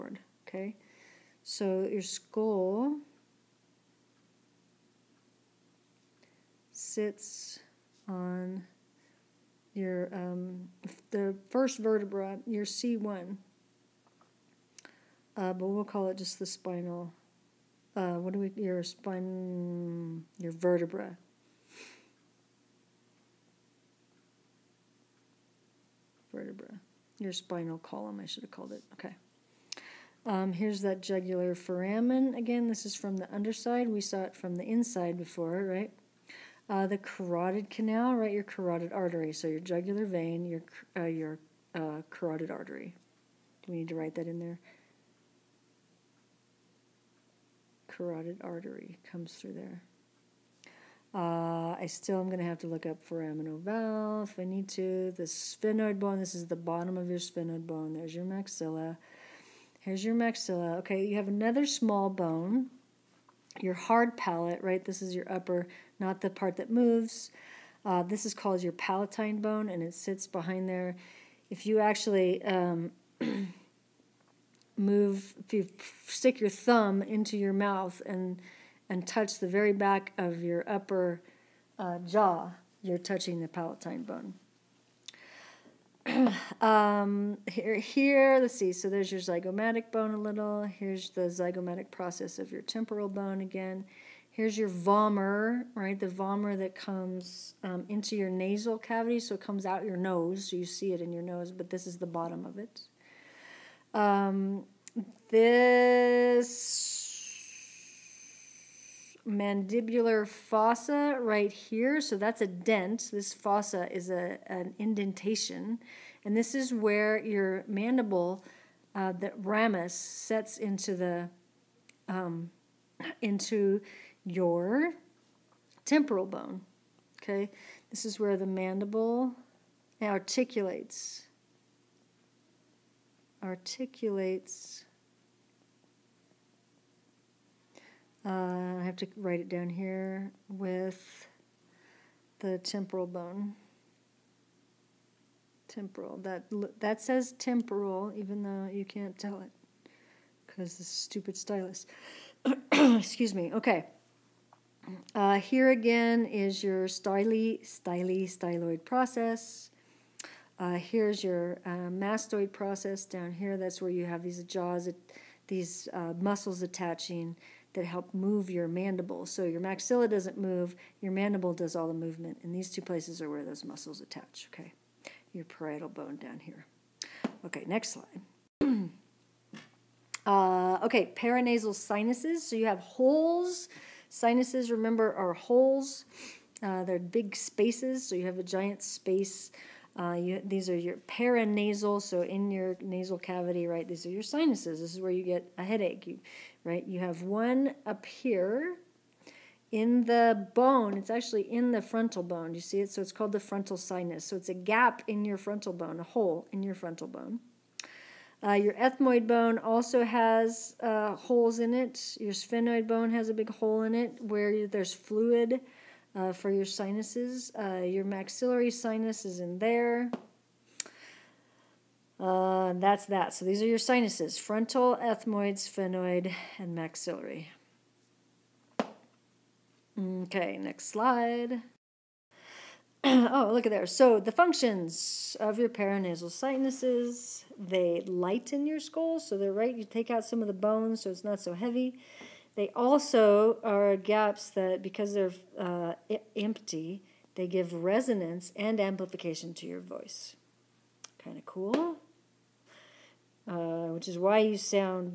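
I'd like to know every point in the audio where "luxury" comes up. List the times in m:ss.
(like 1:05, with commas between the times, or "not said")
not said.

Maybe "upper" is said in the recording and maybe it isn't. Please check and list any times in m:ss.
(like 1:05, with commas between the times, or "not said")
1:05, 1:20.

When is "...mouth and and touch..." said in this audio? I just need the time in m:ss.
1:17.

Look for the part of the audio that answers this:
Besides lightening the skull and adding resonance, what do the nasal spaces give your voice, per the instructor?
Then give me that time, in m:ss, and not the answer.
4:08.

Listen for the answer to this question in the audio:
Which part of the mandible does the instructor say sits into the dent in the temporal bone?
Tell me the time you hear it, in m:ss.
1:59.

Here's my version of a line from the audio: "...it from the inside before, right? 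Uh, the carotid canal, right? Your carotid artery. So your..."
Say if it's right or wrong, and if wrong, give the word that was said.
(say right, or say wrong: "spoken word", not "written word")
right.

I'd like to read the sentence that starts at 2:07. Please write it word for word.
Okay, this is where the mandible articulates articulates uh, I have to write it down here, with the temporal bone.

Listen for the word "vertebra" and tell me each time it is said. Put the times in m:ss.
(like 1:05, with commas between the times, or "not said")
0:11, 0:20, 0:26.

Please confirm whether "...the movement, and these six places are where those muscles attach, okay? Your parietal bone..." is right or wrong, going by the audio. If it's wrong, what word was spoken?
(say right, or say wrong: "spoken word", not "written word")
wrong: "two", not "six".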